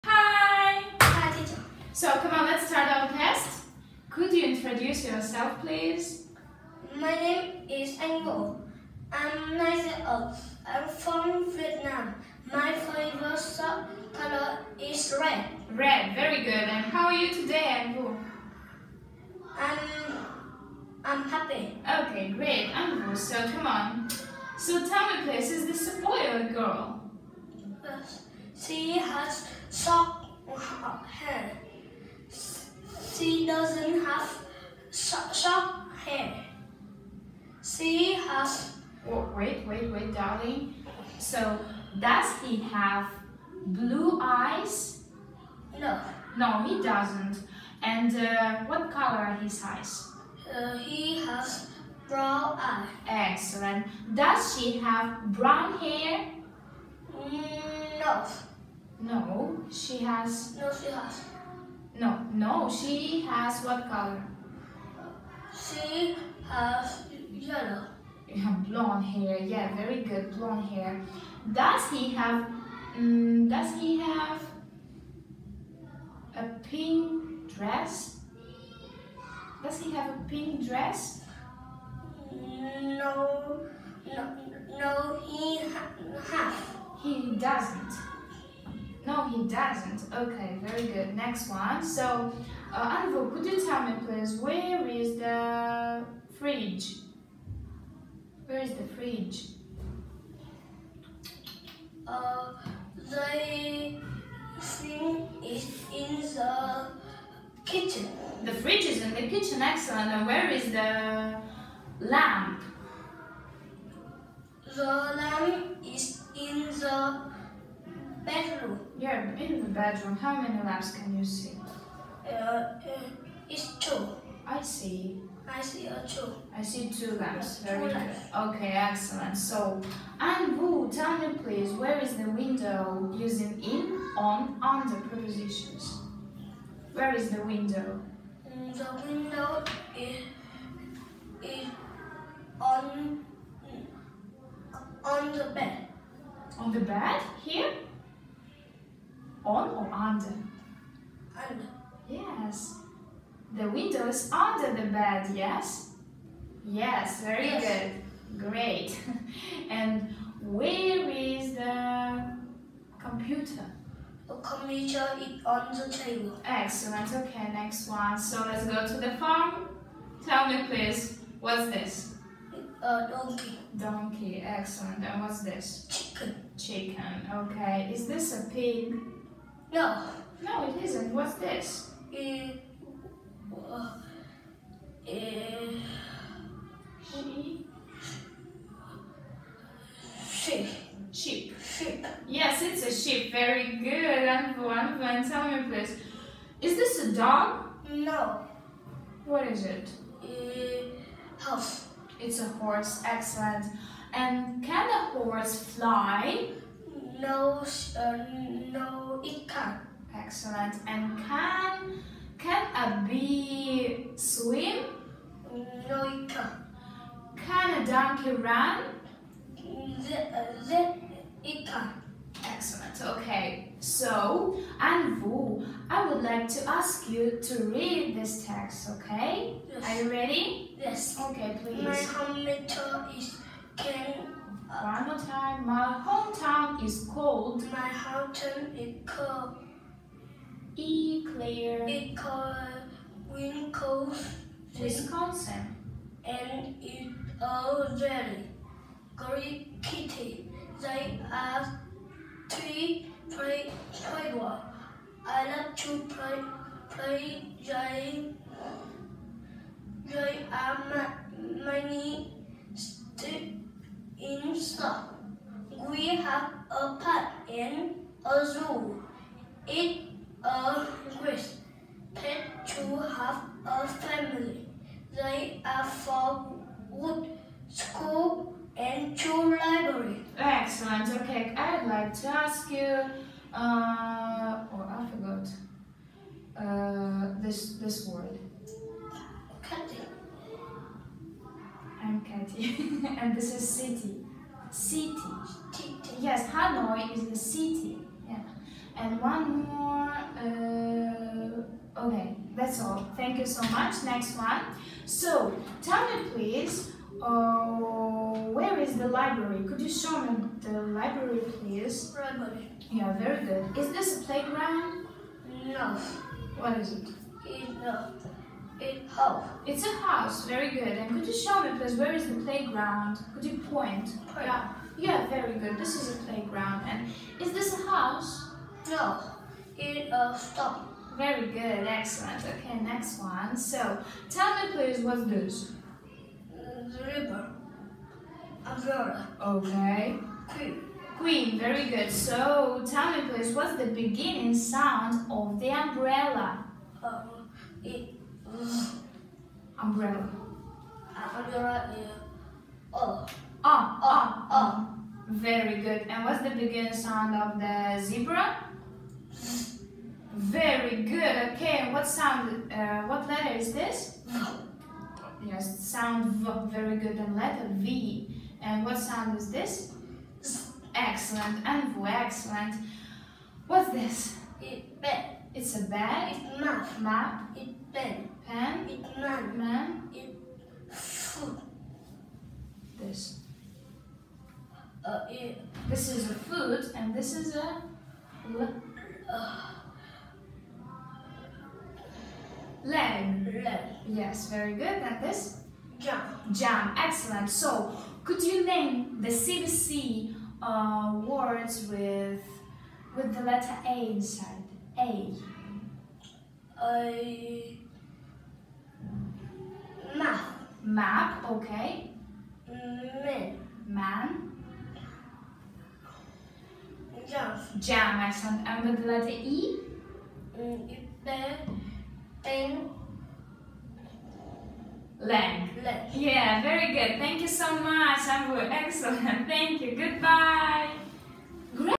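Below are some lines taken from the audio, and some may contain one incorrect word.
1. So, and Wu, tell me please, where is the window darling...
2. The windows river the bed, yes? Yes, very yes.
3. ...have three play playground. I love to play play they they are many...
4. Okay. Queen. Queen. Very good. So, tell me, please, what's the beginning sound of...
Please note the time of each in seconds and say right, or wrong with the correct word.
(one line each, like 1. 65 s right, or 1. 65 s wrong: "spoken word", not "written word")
1. 129 s wrong: "using", not "darling"
2. 153 s wrong: "under", not "river"
3. 251 s right
4. 339 s right.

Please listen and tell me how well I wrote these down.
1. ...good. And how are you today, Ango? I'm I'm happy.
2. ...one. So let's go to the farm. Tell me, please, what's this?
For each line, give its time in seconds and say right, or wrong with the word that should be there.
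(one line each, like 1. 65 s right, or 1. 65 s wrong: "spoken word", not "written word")
1. 16 s right
2. 167 s right.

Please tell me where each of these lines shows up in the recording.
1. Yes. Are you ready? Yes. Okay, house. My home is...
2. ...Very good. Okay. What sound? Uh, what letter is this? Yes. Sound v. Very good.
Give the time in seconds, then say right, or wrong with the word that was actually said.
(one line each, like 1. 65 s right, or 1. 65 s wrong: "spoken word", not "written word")
1. 229 s wrong: "please", not "house"
2. 360 s right.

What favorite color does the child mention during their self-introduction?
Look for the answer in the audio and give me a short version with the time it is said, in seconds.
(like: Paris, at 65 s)
Red, at 12 s.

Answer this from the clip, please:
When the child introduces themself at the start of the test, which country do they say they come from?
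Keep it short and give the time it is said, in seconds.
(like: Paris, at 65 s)
Vietnam, at 10 s.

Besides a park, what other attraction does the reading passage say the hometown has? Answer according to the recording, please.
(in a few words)
A zoo.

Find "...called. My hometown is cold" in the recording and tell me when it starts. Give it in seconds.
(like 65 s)
237 s.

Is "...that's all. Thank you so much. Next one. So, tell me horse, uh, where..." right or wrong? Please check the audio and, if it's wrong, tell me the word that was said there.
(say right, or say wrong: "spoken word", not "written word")
wrong: "please", not "horse".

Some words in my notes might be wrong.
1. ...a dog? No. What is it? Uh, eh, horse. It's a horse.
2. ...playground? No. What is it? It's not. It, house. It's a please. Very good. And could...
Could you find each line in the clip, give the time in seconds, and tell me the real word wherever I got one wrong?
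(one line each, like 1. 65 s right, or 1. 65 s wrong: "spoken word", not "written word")
1. 197 s right
2. 314 s wrong: "house", not "please".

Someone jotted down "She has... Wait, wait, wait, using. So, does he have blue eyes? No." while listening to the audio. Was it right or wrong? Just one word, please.
wrong.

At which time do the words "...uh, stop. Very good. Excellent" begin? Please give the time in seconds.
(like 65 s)
330 s.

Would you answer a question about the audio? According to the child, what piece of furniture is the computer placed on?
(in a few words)
The table.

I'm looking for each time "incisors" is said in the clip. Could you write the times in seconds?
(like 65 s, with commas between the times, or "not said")
not said.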